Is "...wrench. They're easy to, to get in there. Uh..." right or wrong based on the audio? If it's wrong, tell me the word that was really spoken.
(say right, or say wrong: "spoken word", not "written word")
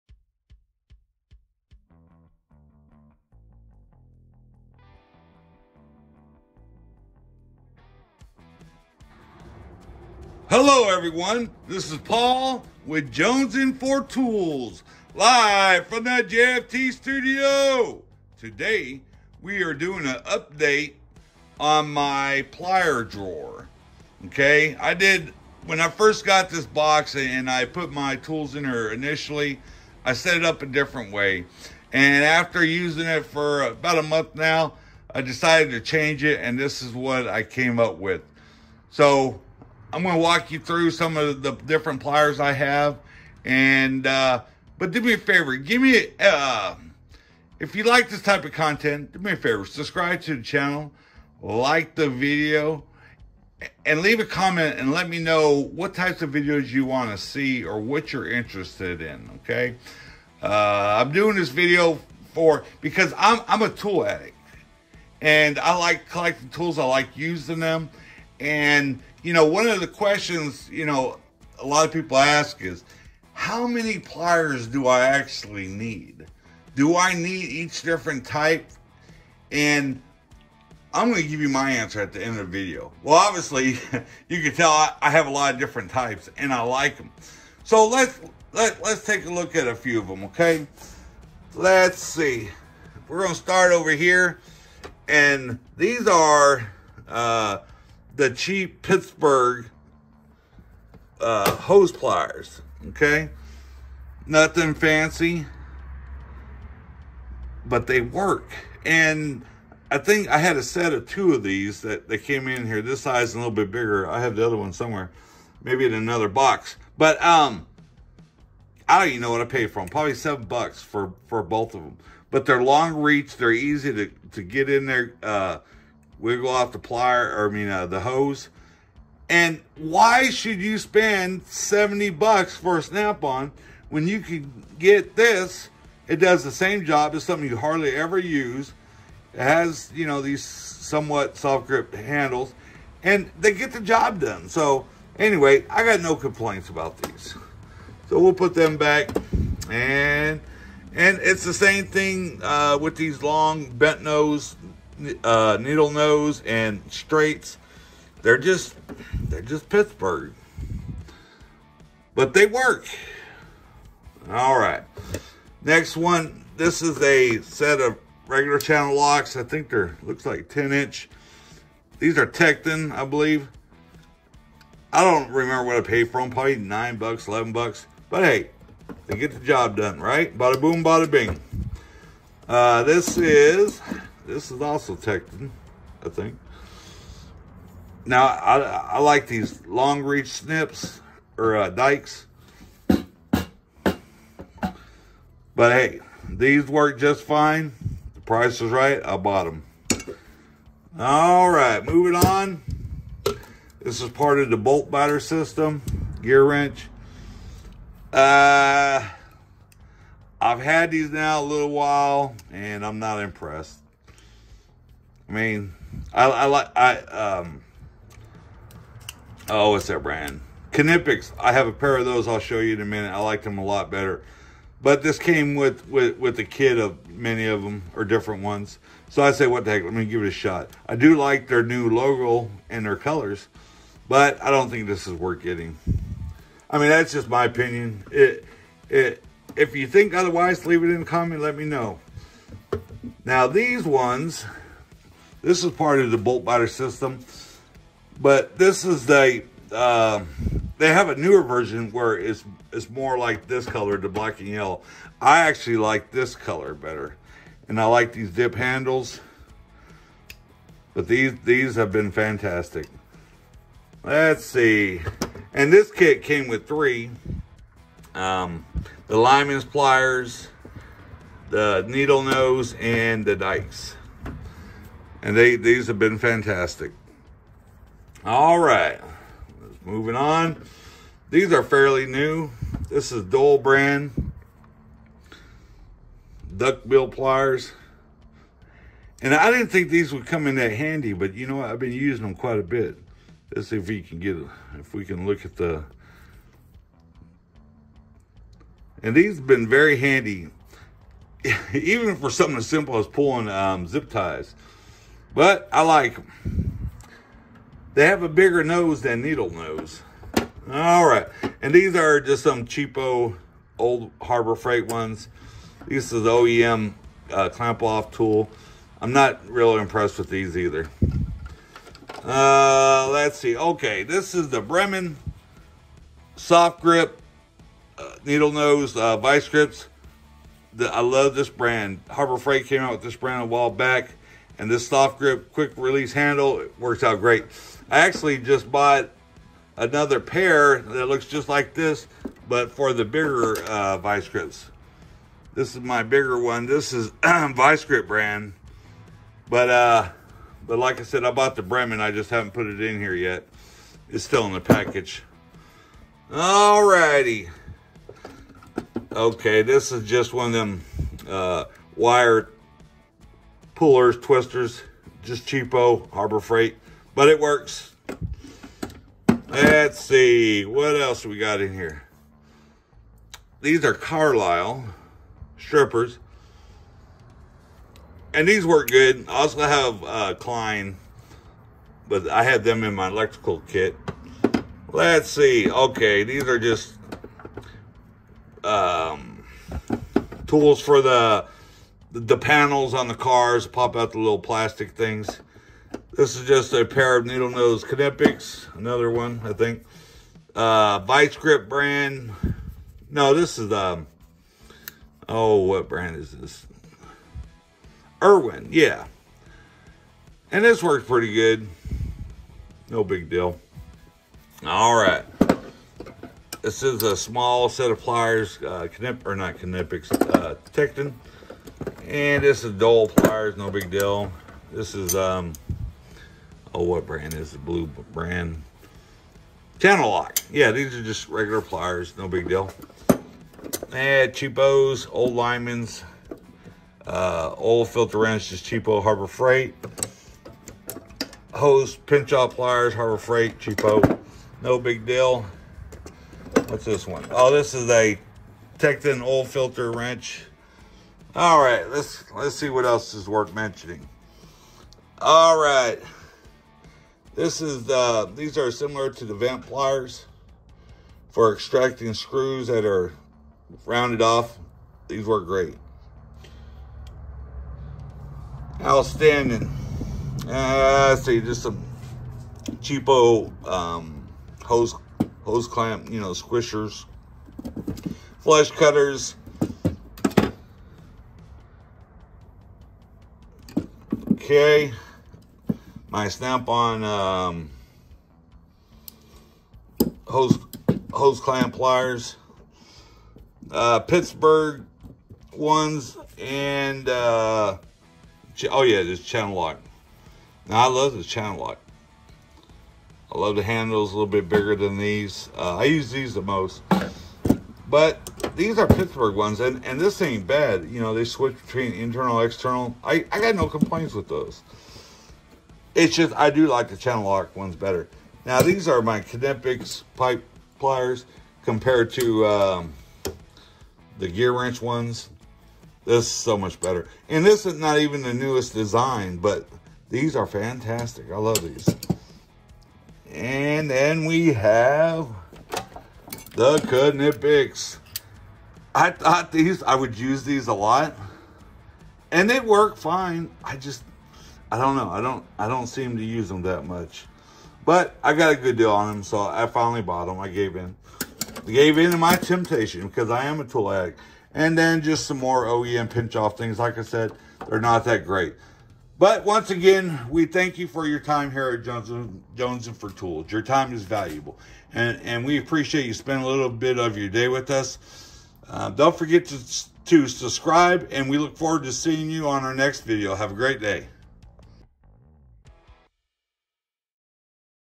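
wrong: "reach", not "wrench".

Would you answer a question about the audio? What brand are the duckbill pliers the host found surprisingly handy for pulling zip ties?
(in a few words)
Doyle.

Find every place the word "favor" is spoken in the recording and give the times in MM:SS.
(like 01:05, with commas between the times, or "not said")
00:45, 00:49.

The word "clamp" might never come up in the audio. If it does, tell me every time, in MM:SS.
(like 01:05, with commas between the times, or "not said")
05:17, 07:55, 08:11.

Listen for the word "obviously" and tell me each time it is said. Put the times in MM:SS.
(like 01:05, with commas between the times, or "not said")
01:23.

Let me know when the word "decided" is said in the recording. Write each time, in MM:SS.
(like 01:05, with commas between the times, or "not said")
00:35.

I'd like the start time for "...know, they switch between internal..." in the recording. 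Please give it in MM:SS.
08:31.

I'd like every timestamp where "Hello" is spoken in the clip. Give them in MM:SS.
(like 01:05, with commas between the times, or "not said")
00:10.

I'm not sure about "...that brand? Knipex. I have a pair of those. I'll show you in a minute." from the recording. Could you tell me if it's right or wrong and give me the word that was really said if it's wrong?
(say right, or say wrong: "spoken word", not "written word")
right.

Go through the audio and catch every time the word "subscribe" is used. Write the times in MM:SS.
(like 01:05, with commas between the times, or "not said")
00:49, 09:30.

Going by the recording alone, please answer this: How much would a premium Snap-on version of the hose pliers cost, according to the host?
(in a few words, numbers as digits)
70 bucks.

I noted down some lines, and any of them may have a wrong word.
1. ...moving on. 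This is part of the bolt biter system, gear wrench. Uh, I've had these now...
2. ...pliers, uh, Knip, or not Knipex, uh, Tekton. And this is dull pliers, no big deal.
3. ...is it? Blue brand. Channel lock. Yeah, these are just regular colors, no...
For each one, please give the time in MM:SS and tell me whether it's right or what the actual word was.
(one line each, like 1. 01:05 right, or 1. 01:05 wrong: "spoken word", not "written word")
1. 03:21 right
2. 06:57 right
3. 07:07 wrong: "pliers", not "colors".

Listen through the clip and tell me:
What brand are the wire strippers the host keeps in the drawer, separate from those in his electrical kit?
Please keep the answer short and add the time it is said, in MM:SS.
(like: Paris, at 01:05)
Carlisle, at 06:13.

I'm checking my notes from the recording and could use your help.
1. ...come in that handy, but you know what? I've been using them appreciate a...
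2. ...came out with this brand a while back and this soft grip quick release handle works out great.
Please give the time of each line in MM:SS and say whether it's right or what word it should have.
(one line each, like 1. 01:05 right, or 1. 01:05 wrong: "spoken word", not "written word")
1. 04:50 wrong: "quite", not "appreciate"
2. 05:32 right.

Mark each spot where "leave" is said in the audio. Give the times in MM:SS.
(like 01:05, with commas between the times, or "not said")
00:54, 04:00.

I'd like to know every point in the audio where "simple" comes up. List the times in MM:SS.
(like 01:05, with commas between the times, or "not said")
05:02.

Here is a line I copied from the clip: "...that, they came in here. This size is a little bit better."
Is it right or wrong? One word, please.
wrong.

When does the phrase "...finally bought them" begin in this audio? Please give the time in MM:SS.
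09:09.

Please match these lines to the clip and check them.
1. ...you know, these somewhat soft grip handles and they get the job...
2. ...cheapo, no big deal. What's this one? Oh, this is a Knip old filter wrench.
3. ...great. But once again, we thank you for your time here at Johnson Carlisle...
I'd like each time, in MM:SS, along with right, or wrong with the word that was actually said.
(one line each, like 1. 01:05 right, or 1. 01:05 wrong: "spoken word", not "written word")
1. 02:19 right
2. 07:23 wrong: "Tekton", not "Knip"
3. 09:18 wrong: "Jonesing", not "Carlisle".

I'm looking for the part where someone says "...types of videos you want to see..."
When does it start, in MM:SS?
00:55.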